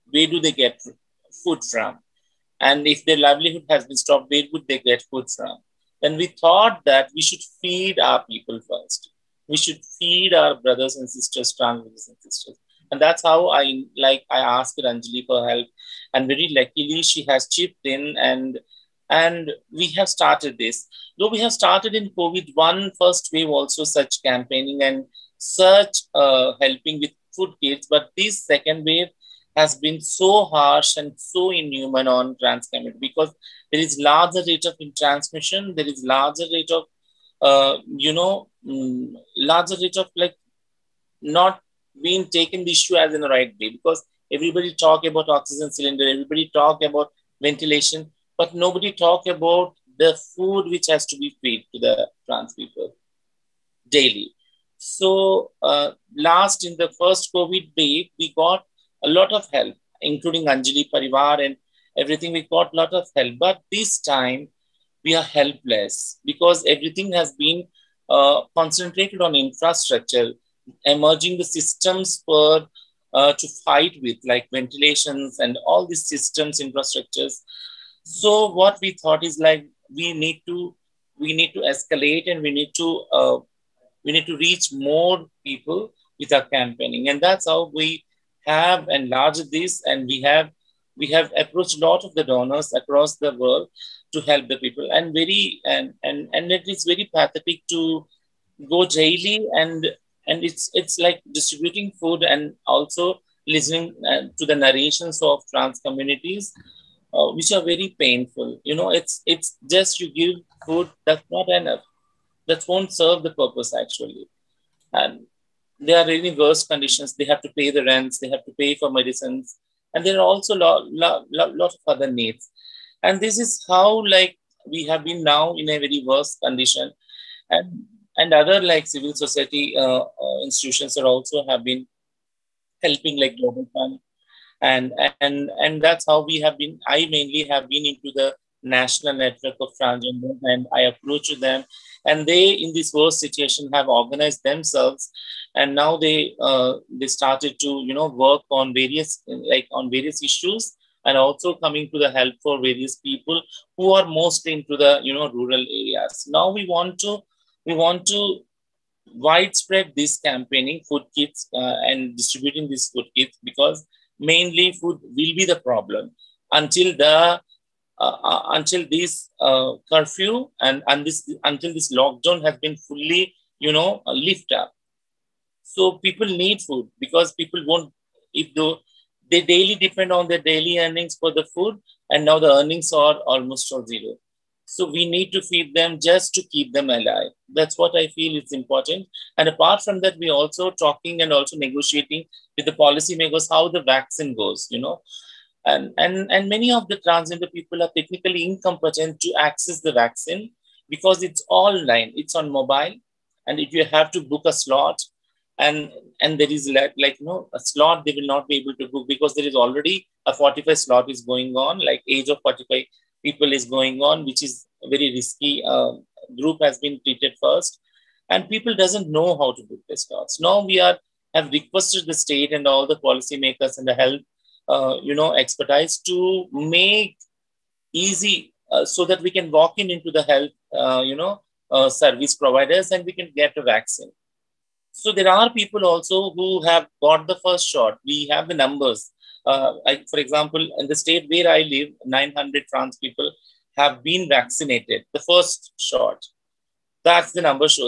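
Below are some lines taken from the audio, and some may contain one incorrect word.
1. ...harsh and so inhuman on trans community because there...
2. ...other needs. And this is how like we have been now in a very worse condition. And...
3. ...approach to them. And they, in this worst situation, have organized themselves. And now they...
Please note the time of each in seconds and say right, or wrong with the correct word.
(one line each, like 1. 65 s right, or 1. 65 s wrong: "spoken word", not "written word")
1. 30 s right
2. 121 s right
3. 140 s right.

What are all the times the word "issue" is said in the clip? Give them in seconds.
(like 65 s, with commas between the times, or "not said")
42 s, 150 s.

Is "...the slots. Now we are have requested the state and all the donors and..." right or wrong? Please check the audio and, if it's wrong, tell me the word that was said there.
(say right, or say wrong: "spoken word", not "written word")
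wrong: "policymakers", not "donors".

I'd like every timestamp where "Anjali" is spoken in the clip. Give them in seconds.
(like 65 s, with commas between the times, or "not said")
14 s, 60 s.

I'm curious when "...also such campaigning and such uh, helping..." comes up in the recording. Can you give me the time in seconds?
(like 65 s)
23 s.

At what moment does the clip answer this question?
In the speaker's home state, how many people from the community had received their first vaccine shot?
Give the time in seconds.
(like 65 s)
242 s.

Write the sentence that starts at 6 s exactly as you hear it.
Then we thought that we should feed our people first.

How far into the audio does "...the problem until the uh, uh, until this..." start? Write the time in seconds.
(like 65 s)
165 s.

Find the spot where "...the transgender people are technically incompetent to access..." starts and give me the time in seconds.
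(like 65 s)
196 s.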